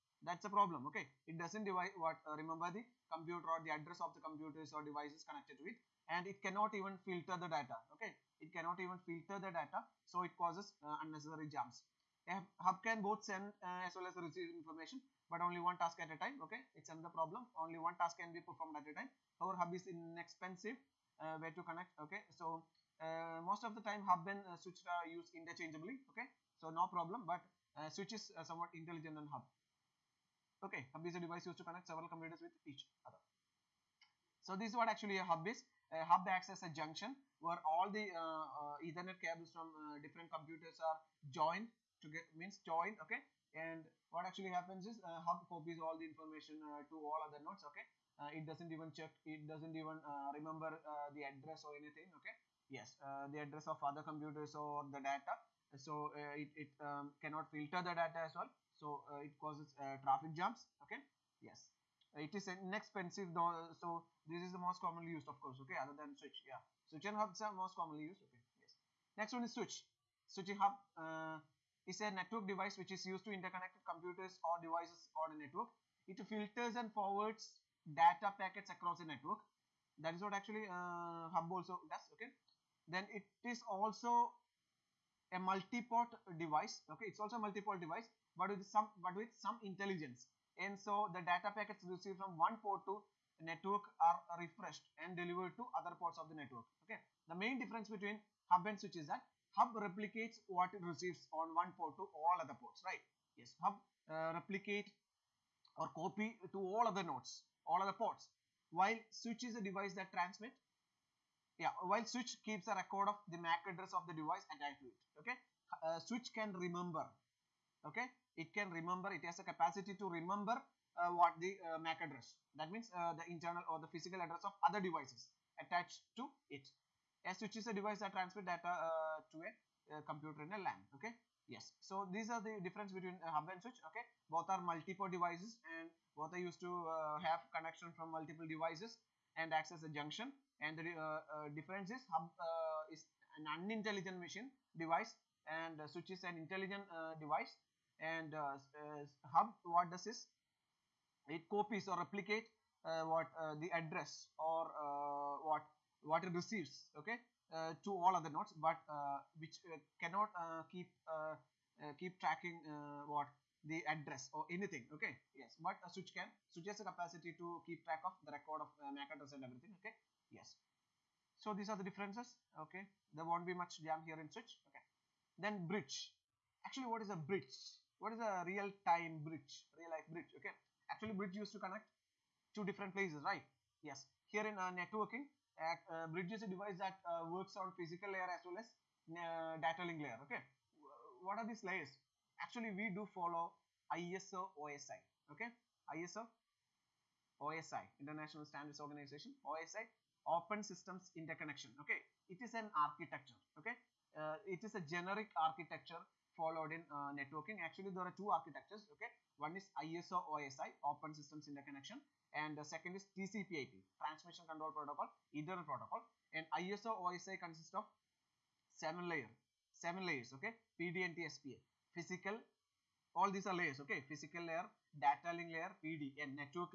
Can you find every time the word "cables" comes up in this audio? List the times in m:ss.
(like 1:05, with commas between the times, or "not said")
0:39.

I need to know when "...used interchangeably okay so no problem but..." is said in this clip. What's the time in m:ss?
0:25.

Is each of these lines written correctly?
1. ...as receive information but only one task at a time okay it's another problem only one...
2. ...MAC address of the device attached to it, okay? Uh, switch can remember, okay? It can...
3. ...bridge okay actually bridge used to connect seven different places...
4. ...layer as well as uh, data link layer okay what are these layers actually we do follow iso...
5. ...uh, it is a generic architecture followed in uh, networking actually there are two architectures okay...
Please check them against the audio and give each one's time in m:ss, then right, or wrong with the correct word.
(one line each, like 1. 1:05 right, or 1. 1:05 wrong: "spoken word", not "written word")
1. 0:14 right
2. 1:53 right
3. 3:00 wrong: "two", not "seven"
4. 3:08 right
5. 3:24 right.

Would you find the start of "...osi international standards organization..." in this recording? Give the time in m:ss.
3:17.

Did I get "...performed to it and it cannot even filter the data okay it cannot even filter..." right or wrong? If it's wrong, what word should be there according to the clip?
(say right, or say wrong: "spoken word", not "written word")
wrong: "connected", not "performed".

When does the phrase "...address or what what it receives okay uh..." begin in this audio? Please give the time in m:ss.
2:33.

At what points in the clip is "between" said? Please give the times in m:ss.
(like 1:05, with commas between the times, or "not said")
1:37, 2:12.